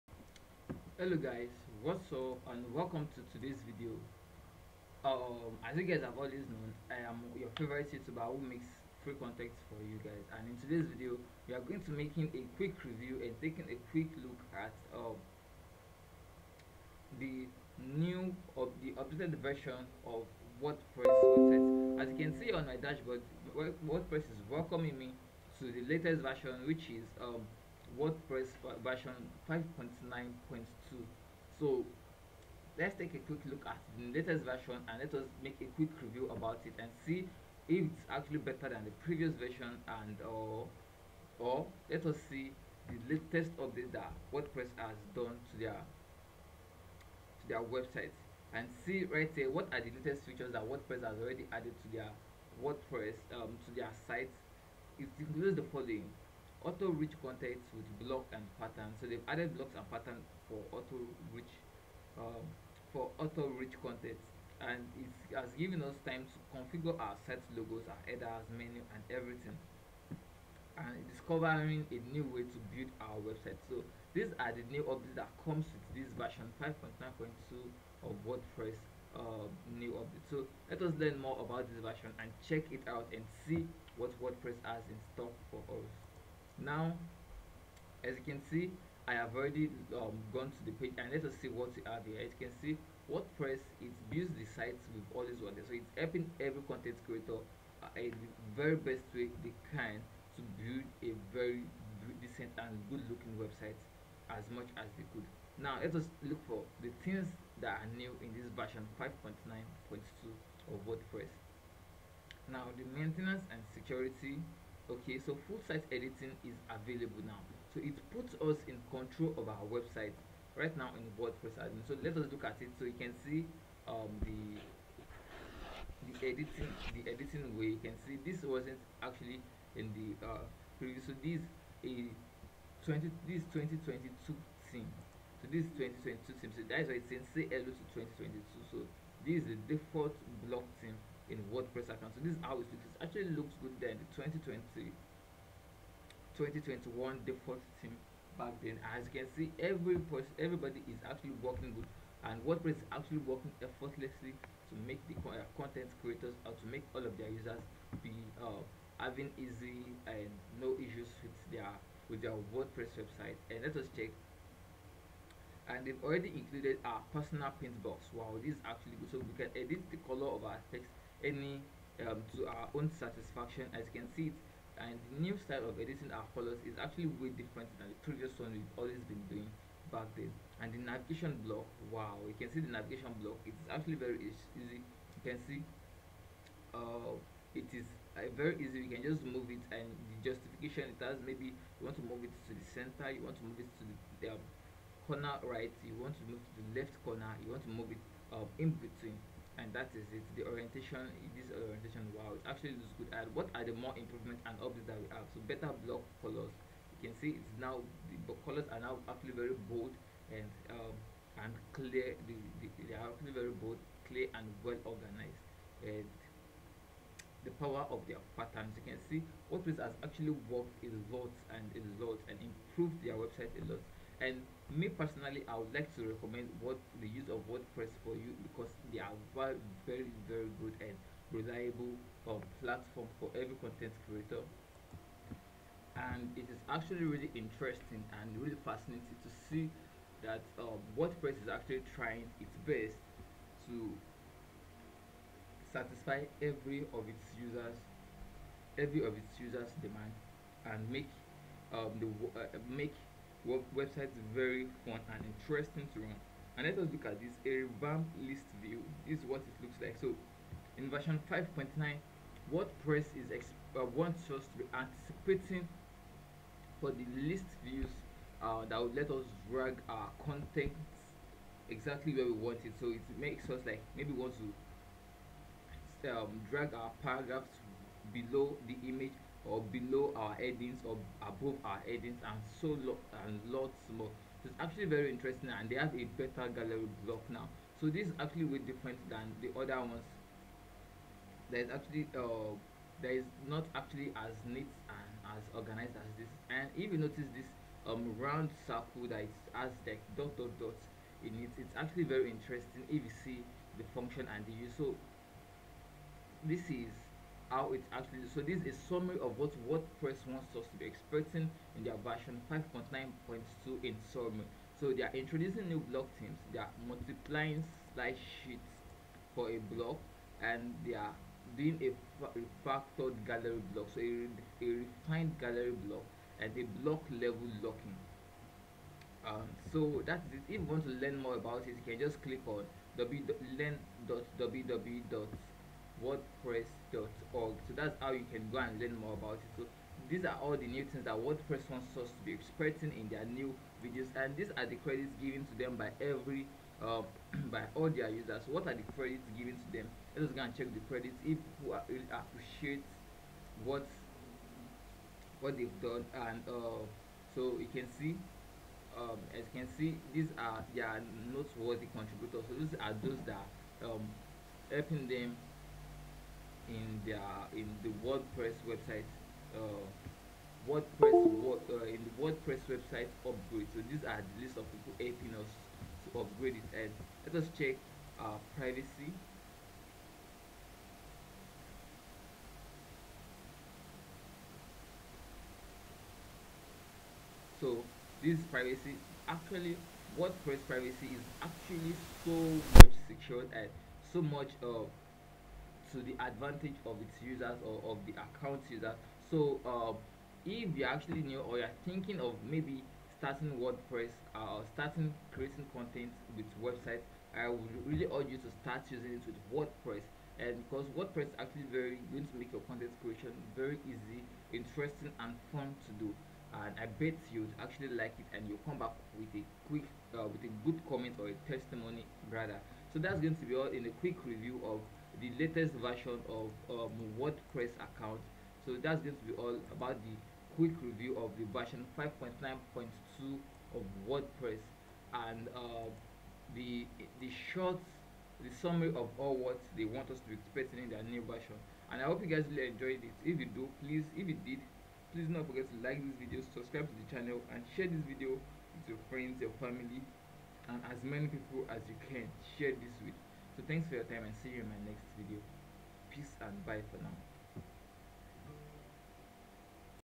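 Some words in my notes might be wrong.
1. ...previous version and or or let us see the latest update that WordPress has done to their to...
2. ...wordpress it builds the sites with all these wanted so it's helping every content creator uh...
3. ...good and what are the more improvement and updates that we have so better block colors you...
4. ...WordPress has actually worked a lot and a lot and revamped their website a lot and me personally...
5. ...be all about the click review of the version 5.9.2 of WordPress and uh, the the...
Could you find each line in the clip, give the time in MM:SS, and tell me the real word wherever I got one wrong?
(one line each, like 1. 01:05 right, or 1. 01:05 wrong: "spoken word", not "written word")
1. 00:39 right
2. 01:33 right
3. 03:22 right
4. 03:39 wrong: "improved", not "revamped"
5. 07:09 wrong: "quick", not "click".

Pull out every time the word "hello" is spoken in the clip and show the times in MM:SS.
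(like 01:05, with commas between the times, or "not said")
00:01, 02:17.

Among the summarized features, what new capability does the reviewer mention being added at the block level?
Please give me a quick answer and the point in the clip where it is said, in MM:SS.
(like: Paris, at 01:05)
block level locking, at 05:26.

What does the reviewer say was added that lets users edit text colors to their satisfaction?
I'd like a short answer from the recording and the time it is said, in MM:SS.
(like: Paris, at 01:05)
personal paint box, at 02:47.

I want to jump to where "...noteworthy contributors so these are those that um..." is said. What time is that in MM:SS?
06:01.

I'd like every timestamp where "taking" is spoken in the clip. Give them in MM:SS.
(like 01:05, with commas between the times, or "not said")
00:13.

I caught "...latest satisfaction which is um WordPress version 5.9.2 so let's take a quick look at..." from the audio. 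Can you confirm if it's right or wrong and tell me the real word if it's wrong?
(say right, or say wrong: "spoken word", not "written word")
wrong: "version", not "satisfaction".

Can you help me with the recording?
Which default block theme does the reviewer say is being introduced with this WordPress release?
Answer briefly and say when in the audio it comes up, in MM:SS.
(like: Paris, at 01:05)
2022, at 02:17.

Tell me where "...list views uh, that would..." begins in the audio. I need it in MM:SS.
04:27.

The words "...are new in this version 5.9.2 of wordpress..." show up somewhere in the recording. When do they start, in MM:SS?
01:47.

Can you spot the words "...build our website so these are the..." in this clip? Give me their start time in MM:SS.
01:12.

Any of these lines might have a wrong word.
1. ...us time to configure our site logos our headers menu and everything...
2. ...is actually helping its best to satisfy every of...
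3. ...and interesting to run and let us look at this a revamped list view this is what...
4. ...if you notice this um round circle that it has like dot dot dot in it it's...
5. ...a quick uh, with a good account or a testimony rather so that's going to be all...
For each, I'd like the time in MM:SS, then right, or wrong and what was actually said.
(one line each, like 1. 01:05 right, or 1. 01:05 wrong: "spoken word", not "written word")
1. 01:05 right
2. 04:01 wrong: "trying", not "helping"
3. 04:15 right
4. 04:56 right
5. 06:59 wrong: "comment", not "account".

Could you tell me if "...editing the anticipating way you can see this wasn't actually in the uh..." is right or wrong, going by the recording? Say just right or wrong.
wrong.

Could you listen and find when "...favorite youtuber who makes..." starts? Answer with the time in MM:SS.
00:07.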